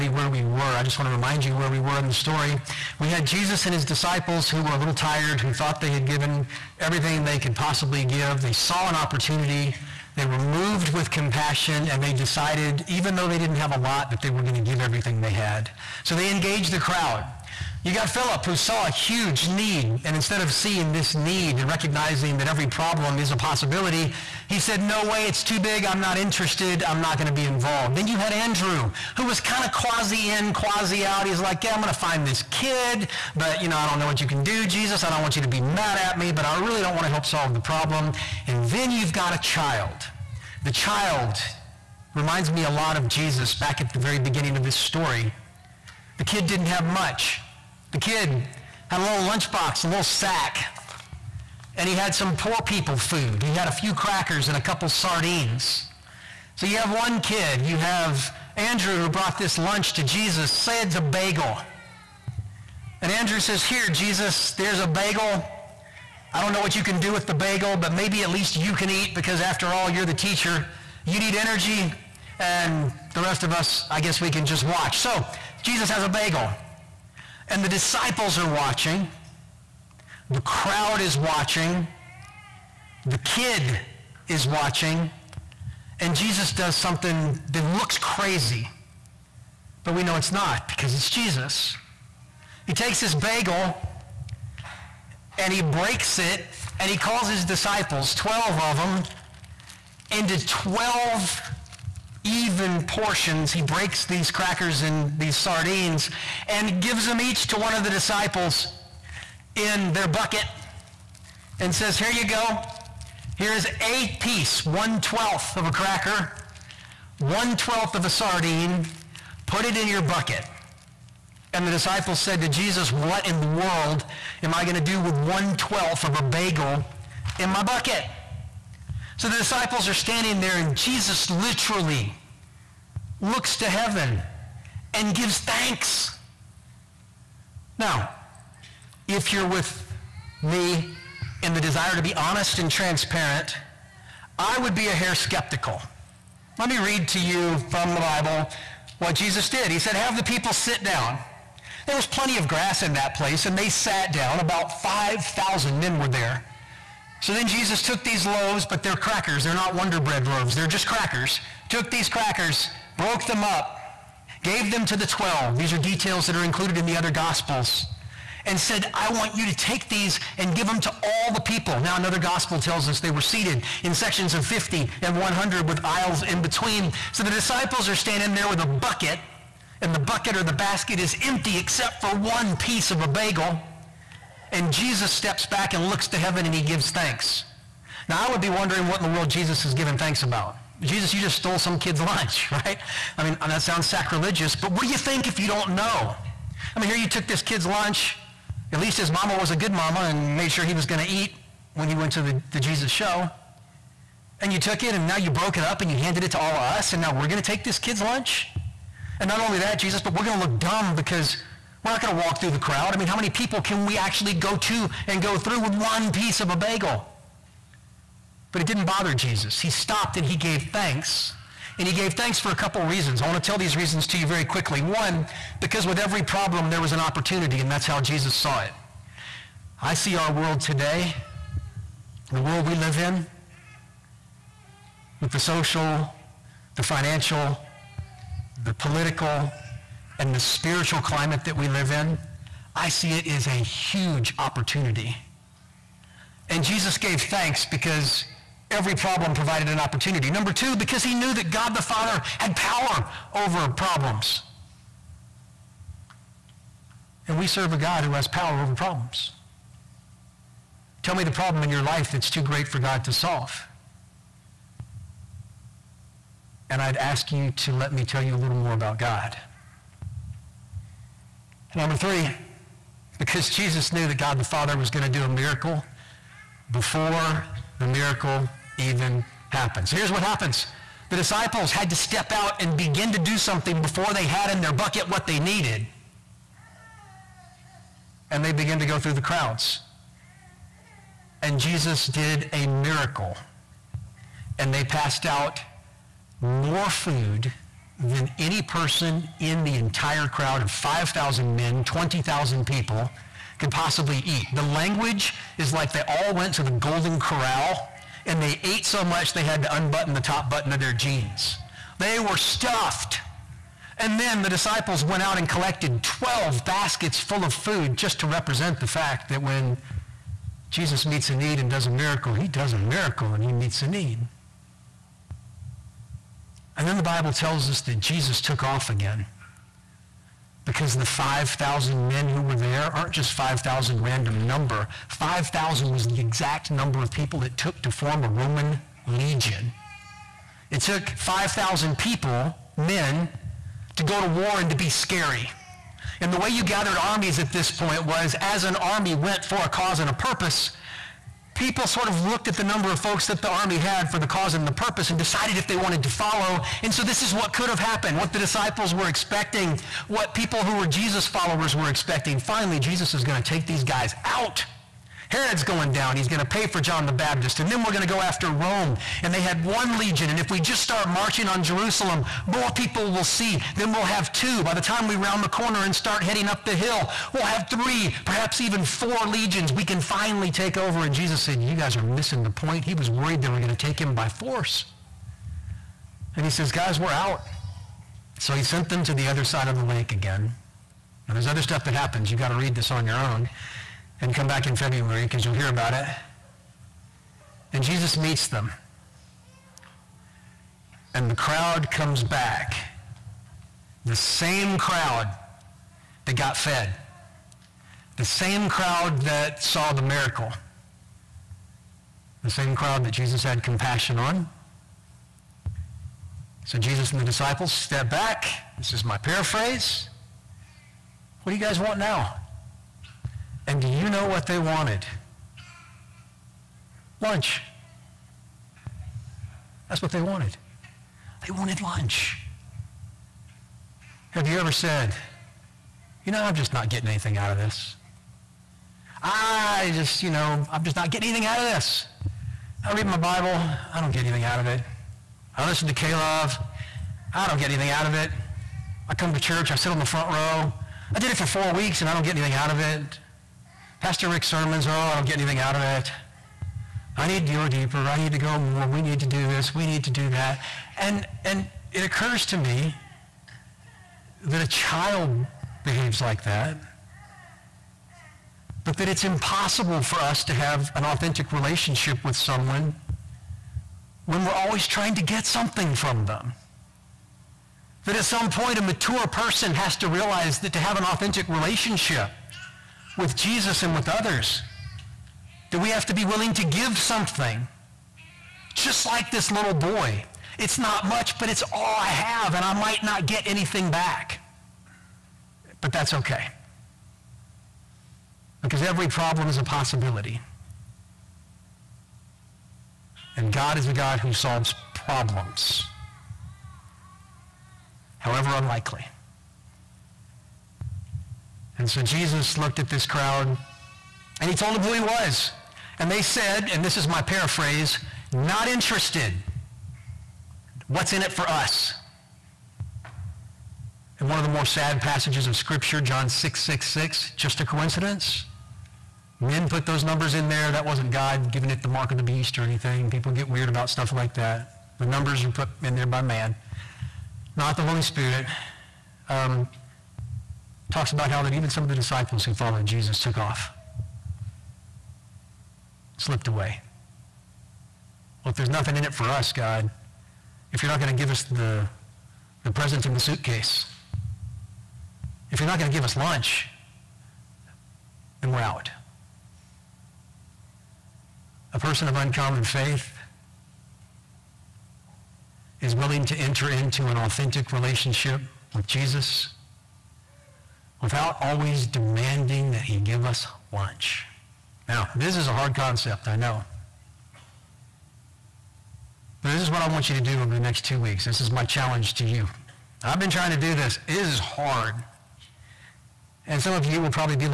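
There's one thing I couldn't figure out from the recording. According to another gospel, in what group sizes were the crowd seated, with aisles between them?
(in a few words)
50 and 100.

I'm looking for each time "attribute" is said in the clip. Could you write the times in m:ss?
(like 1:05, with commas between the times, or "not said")
not said.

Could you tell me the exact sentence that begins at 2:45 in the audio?
These are details that are included in the other gospels.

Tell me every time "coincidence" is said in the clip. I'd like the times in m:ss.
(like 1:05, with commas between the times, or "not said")
8:47.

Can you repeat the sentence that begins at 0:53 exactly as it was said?
He had a few crackers and a couple sardines.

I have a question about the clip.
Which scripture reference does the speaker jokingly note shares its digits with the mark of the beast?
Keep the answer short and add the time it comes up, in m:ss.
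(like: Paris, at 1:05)
John 6:66, at 8:46.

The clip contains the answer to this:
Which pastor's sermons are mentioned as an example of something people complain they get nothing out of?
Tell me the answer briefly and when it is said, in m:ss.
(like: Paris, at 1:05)
Pastor Rick, at 7:34.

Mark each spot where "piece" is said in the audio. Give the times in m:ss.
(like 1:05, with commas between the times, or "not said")
1:54, 3:02, 3:36.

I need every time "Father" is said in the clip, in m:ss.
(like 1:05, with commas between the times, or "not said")
4:11, 4:34.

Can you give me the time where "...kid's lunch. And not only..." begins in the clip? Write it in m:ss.
3:27.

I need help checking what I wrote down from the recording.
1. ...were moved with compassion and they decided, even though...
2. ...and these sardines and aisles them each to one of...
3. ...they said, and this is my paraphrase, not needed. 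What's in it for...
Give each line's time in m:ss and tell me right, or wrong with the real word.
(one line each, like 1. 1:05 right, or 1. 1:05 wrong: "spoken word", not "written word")
1. 0:10 right
2. 1:44 wrong: "gives", not "aisles"
3. 8:36 wrong: "interested", not "needed".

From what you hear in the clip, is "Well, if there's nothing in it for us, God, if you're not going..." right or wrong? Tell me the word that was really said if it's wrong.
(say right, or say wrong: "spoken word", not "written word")
right.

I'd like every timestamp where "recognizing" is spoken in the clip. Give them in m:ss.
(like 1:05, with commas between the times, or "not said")
0:21.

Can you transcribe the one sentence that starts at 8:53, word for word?
People get weird about stuff like that.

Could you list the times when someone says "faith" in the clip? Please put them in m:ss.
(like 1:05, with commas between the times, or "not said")
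9:22.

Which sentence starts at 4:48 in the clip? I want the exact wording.
And they began to go through the crowds.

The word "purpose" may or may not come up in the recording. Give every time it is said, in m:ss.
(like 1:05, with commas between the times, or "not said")
5:50, 5:54.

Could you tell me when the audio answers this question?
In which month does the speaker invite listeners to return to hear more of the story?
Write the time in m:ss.
6:34.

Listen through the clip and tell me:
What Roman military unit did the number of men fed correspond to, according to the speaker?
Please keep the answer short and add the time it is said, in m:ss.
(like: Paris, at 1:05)
Roman legion, at 5:38.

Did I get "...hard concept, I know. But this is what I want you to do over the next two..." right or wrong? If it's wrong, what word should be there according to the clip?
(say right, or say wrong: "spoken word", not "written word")
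right.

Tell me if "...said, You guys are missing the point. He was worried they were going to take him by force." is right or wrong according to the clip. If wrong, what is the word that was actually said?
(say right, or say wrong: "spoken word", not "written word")
right.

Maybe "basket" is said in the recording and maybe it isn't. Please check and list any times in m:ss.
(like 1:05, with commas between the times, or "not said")
3:00, 5:16.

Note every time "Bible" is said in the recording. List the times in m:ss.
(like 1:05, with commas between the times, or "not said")
2:28, 5:27, 7:23.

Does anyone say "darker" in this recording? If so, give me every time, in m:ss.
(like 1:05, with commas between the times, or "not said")
not said.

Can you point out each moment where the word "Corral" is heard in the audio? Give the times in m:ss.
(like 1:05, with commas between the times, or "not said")
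5:07.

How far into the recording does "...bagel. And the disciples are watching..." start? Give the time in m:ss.
1:16.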